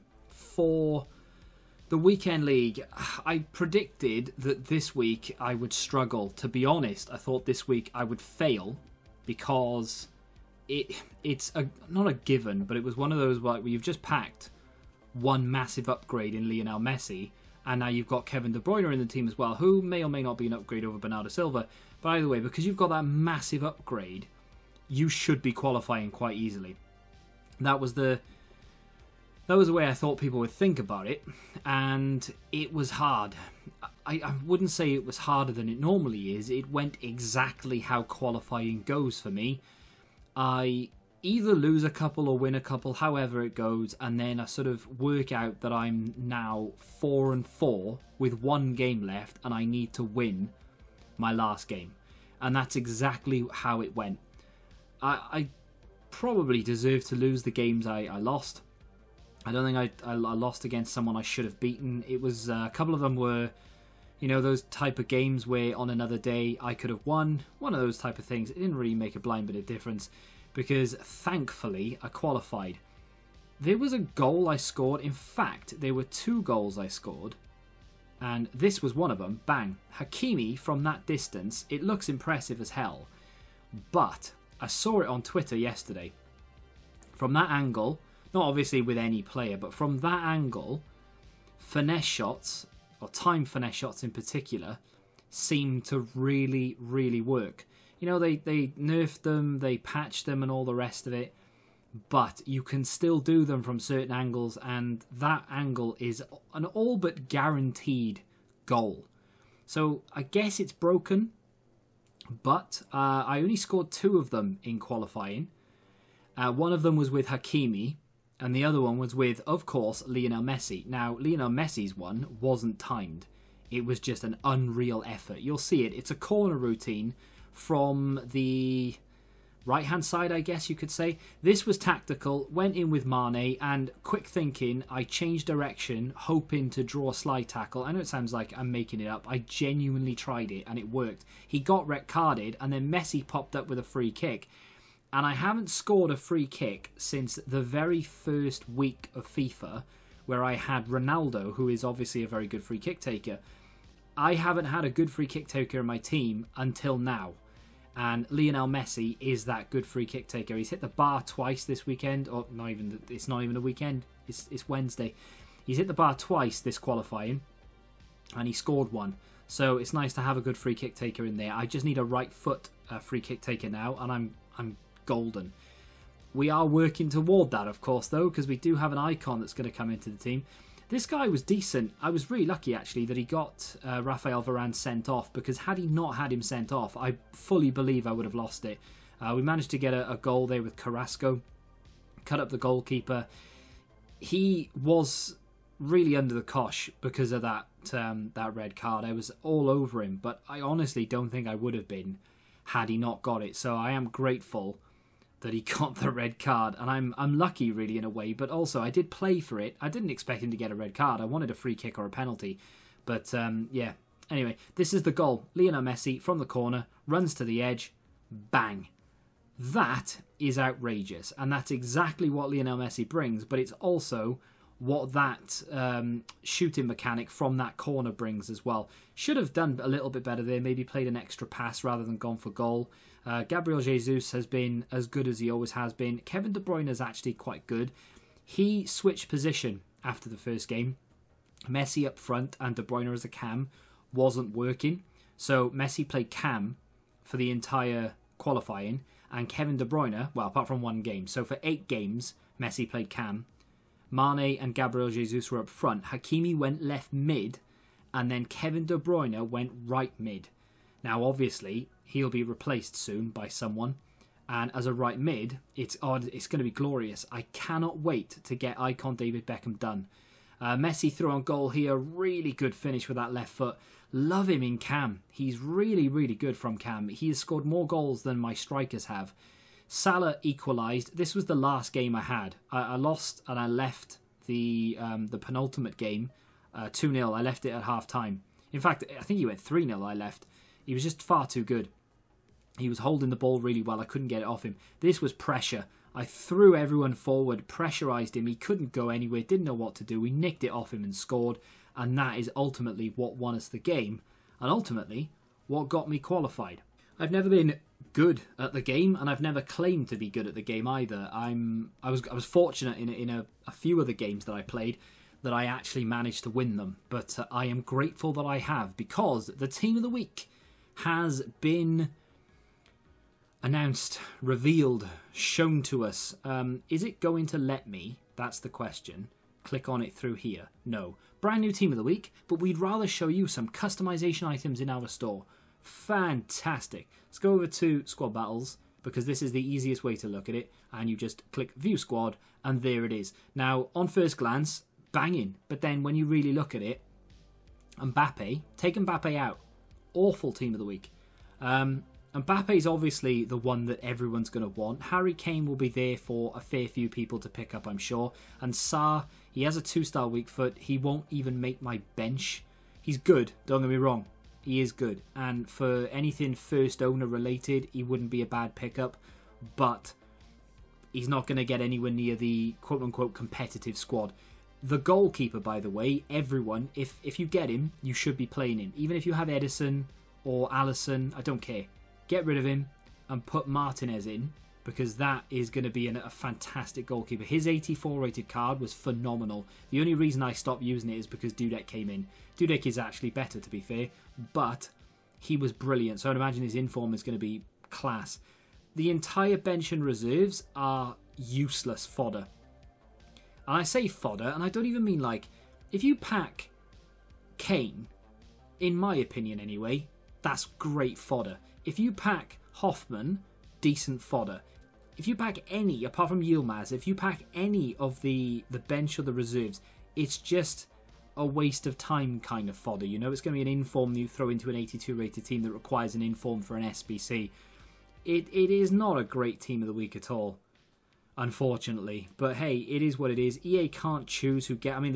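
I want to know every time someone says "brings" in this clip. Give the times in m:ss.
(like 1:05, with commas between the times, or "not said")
3:43, 3:48.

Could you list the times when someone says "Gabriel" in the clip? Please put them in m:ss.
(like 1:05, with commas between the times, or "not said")
3:53, 4:14.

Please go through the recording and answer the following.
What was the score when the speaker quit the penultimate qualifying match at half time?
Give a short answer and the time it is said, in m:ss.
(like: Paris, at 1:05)
2-0, at 4:46.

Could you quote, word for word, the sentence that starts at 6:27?
His 84 rated card was phenomenal.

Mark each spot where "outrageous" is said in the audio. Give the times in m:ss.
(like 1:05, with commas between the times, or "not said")
3:40.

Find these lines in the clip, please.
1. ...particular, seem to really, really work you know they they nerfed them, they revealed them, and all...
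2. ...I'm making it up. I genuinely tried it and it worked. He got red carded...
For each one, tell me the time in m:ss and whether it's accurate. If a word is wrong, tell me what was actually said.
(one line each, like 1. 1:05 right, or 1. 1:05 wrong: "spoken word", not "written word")
1. 1:34 wrong: "patched", not "revealed"
2. 2:18 right.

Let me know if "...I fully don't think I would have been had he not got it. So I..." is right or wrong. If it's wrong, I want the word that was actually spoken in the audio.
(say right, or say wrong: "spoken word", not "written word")
wrong: "honestly", not "fully".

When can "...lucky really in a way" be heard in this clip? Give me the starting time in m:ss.
3:27.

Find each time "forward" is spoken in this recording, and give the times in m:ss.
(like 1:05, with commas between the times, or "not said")
4:57.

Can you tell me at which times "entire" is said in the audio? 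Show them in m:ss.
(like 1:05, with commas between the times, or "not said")
4:07, 6:39.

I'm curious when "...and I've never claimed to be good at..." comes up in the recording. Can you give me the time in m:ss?
5:09.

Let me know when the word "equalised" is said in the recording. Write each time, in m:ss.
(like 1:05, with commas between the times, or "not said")
4:40.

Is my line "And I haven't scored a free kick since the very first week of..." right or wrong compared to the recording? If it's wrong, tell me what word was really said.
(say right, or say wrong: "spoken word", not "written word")
right.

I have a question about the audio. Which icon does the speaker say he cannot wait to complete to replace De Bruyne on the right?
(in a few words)
David Beckham.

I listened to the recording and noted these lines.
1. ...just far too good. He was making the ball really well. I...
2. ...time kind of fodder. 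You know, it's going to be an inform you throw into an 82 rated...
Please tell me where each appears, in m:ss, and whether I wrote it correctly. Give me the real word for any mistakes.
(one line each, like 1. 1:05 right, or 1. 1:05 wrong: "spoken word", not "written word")
1. 4:51 wrong: "holding", not "making"
2. 7:01 right.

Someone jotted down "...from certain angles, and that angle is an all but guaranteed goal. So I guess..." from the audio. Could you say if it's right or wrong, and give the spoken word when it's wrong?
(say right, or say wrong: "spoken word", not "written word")
right.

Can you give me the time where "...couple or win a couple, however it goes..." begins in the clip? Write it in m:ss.
0:41.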